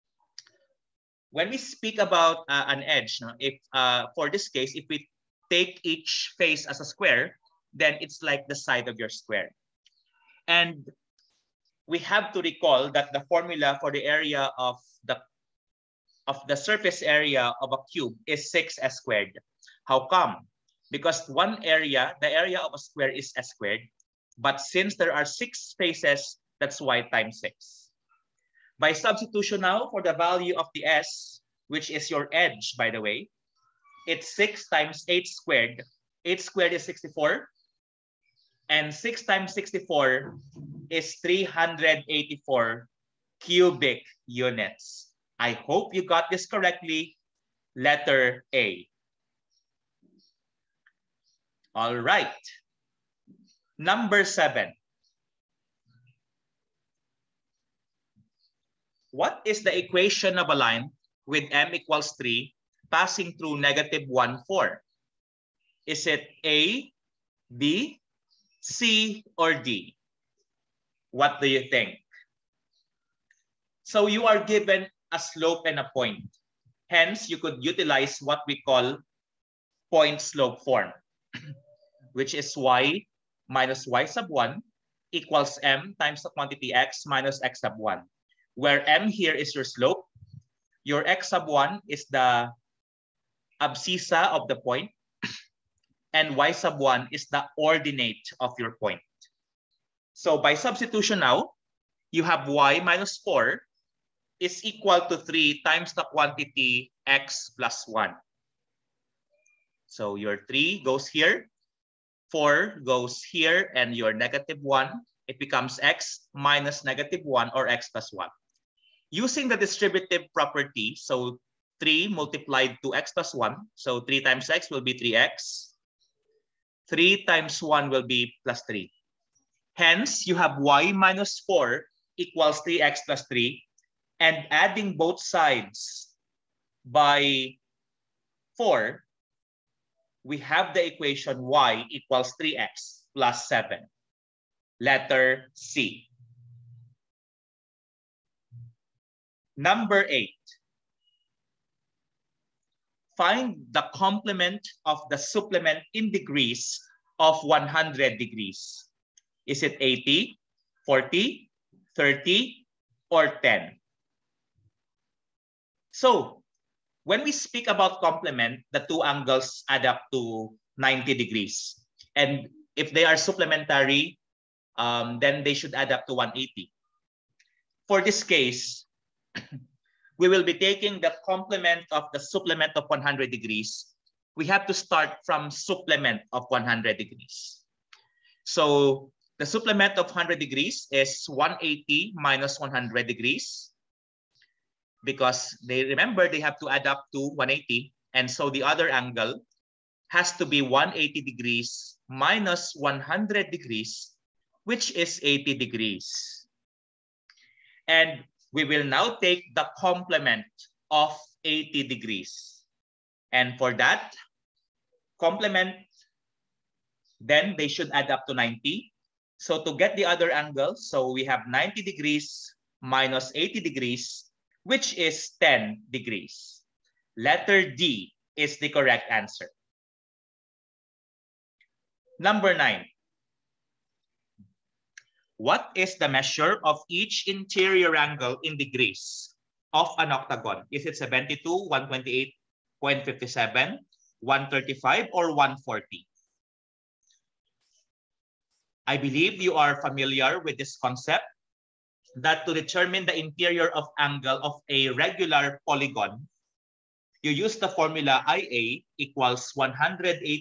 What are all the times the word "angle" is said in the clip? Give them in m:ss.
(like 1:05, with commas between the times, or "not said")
2:49, 3:18, 3:40, 3:57, 4:13.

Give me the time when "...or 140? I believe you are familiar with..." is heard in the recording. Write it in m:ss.
4:05.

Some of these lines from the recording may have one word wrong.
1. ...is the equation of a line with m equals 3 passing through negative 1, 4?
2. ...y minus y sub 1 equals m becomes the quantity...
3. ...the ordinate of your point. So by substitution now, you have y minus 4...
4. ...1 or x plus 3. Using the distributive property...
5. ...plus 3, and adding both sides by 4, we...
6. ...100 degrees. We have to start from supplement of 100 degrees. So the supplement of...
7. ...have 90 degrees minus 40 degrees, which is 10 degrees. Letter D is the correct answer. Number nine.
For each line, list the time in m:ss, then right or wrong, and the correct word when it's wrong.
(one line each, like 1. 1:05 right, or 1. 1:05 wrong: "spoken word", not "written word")
1. 0:59 right
2. 1:22 wrong: "times", not "becomes"
3. 1:37 right
4. 1:57 wrong: "1", not "3"
5. 2:13 right
6. 3:02 right
7. 3:41 wrong: "80", not "40".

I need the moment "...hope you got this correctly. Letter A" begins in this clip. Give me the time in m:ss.
0:45.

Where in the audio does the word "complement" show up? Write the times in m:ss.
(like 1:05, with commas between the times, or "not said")
2:33, 2:48, 3:01, 3:29, 3:35.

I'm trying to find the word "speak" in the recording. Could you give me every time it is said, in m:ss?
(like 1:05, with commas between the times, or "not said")
0:01, 2:47.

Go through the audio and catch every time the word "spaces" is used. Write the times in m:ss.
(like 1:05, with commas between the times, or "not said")
0:25.